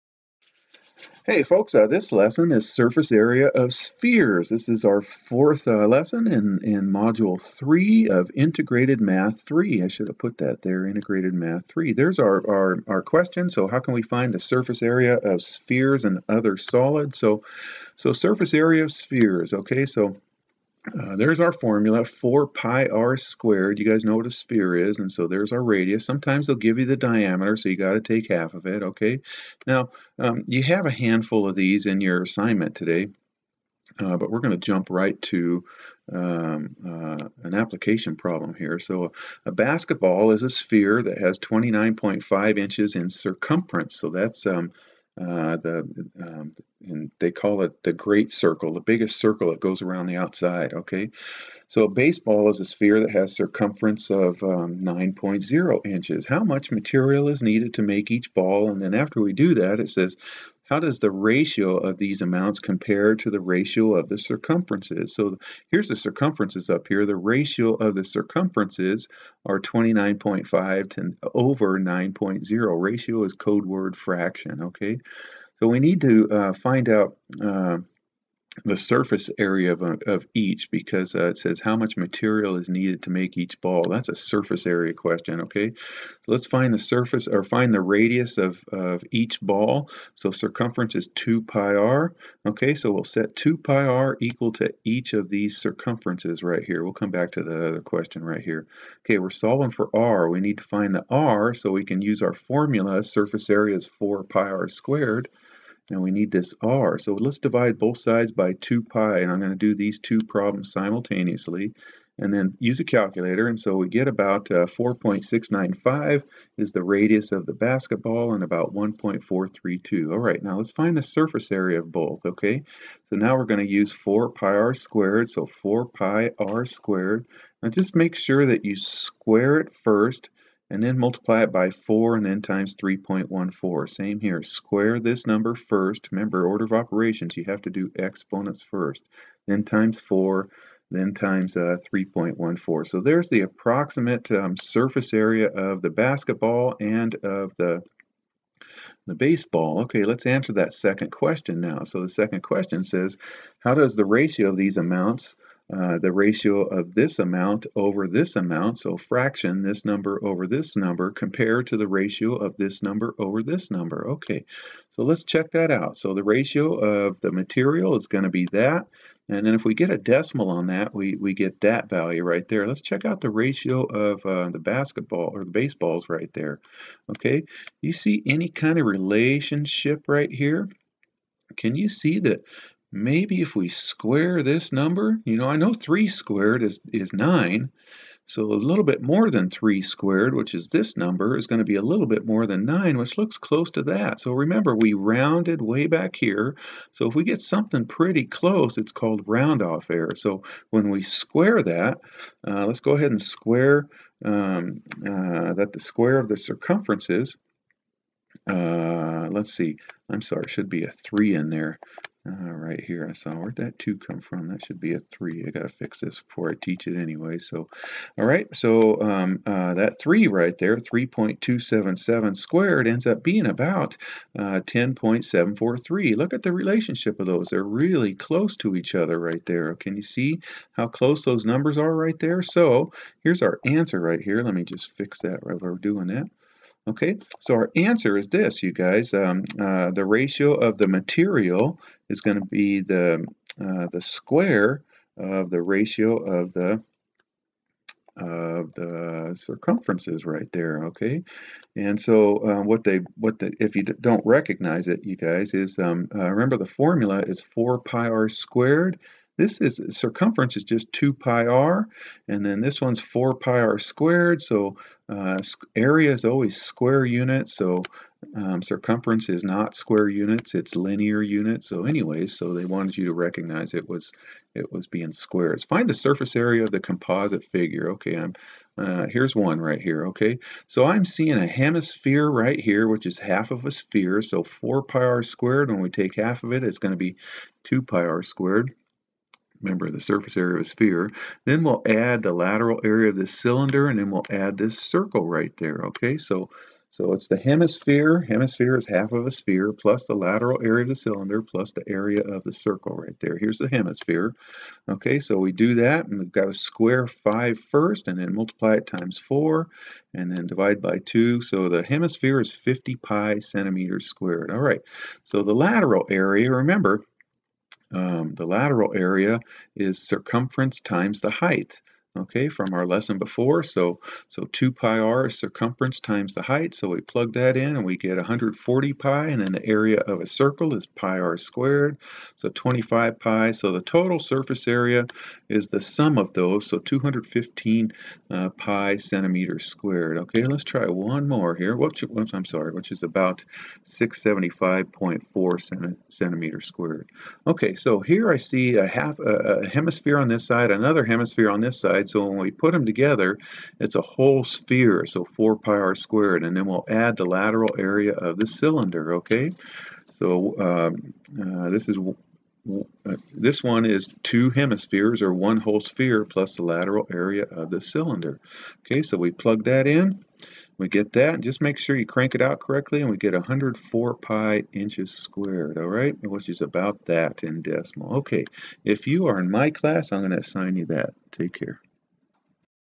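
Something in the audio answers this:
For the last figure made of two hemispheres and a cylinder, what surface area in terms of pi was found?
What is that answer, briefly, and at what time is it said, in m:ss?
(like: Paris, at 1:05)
104 pi square inches, at 6:13.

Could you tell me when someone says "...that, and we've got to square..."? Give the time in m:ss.
5:05.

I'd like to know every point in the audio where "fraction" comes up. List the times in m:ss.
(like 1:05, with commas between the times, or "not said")
1:13, 2:38.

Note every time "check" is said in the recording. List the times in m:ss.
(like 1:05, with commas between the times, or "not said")
2:45, 2:52.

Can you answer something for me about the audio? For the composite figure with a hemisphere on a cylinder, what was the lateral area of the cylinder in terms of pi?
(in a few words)
140 pi.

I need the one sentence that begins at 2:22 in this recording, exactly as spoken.
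So there's the approximate um, surface area of the basketball and of the the baseball.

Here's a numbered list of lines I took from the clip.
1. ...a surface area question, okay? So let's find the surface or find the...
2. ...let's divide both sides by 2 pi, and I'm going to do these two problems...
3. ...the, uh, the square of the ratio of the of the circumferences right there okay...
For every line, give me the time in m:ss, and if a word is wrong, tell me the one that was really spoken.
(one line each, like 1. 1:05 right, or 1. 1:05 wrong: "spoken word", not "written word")
1. 1:24 right
2. 1:47 right
3. 4:02 right.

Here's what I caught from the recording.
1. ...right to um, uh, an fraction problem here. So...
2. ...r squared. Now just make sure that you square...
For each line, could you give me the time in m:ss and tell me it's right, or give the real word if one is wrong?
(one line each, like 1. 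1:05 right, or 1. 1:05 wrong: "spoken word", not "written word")
1. 0:34 wrong: "application", not "fraction"
2. 2:06 right.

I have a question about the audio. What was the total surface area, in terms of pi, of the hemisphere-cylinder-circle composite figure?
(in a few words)
215 pi square centimeters.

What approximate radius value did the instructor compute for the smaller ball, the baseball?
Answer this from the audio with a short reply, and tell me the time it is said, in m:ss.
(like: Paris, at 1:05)
1.432, at 1:58.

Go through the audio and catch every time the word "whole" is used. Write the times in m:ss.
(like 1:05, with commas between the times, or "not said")
5:54, 6:05.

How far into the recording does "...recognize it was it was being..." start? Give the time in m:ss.
4:33.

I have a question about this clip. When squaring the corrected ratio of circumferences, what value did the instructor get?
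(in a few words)
10.743.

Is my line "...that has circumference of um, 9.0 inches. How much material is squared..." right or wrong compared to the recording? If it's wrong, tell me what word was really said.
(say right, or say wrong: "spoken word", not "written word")
wrong: "needed", not "squared".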